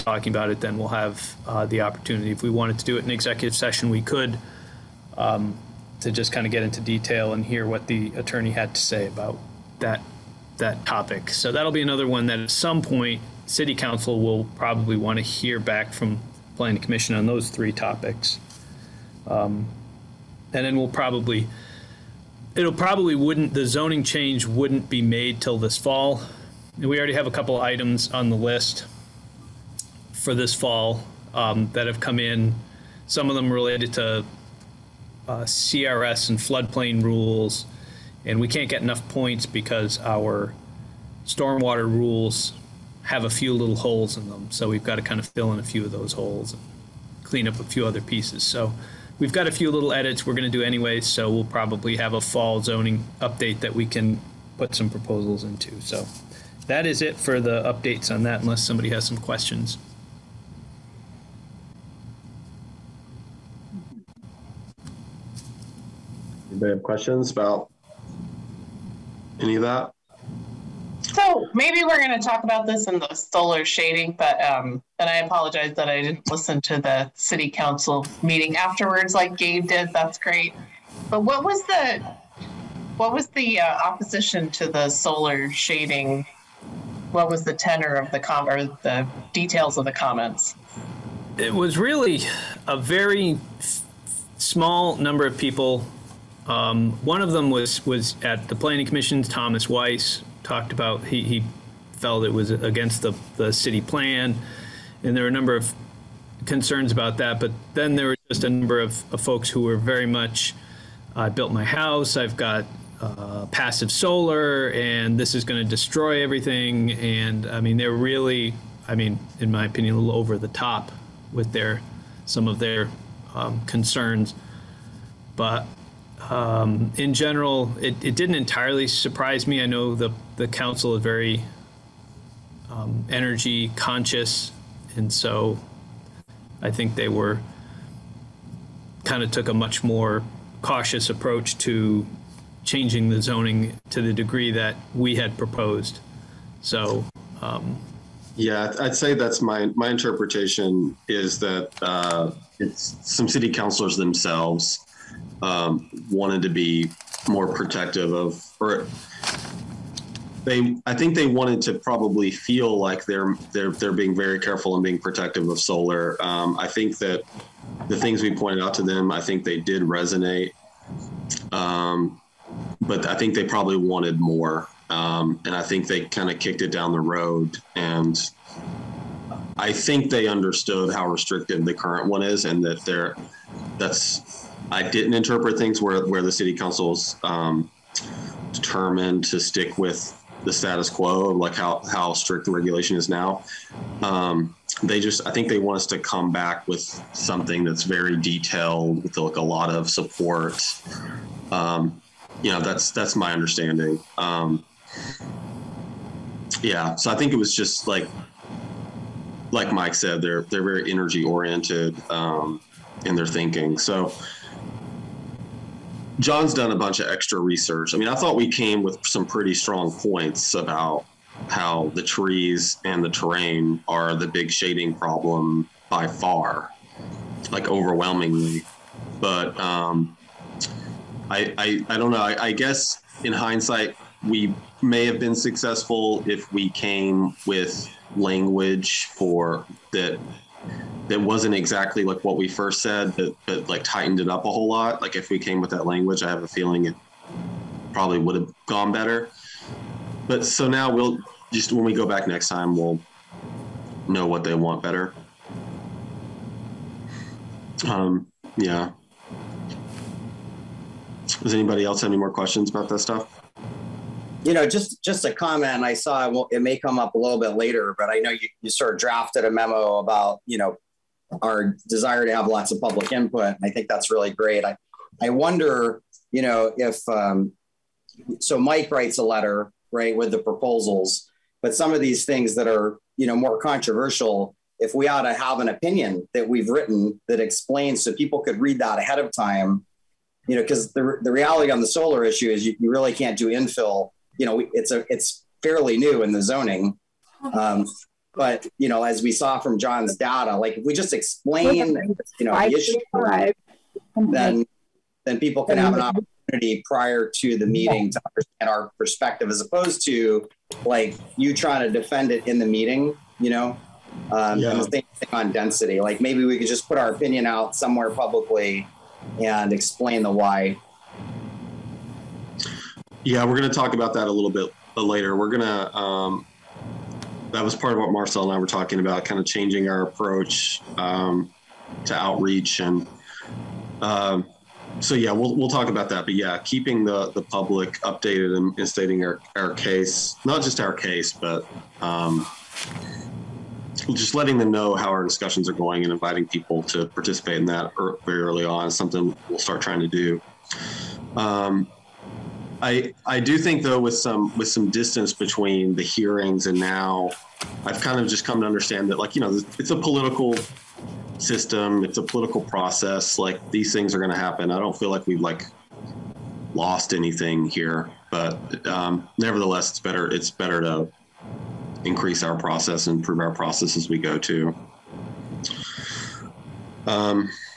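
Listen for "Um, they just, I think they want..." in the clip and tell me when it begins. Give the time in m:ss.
3:14.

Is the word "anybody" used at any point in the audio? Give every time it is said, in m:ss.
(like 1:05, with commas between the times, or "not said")
1:06, 4:21.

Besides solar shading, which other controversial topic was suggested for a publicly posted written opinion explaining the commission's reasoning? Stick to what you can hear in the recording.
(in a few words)
density.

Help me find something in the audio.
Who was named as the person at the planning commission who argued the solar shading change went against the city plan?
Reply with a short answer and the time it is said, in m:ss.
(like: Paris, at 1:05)
Thomas Weiss, at 1:39.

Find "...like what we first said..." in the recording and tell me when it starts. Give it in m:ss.
4:02.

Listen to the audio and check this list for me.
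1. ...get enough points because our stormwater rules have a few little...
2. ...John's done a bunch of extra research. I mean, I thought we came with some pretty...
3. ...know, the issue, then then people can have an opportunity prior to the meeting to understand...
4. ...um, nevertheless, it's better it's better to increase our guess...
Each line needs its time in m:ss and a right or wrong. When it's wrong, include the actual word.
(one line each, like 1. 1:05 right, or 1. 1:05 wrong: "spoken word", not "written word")
1. 0:38 right
2. 3:36 right
3. 5:02 right
4. 6:08 wrong: "process", not "guess".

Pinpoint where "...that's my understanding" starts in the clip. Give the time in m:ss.
3:22.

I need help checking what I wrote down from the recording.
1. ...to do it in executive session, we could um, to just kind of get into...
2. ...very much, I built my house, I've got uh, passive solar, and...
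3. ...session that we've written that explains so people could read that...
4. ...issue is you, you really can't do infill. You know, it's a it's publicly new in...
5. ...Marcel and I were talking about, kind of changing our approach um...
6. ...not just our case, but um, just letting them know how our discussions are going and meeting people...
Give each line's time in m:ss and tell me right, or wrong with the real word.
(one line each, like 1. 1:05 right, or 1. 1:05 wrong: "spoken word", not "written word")
1. 0:02 right
2. 1:49 right
3. 4:45 wrong: "opinion", not "session"
4. 4:52 wrong: "fairly", not "publicly"
5. 5:28 right
6. 5:40 wrong: "inviting", not "meeting".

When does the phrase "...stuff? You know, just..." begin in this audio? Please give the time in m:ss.
4:22.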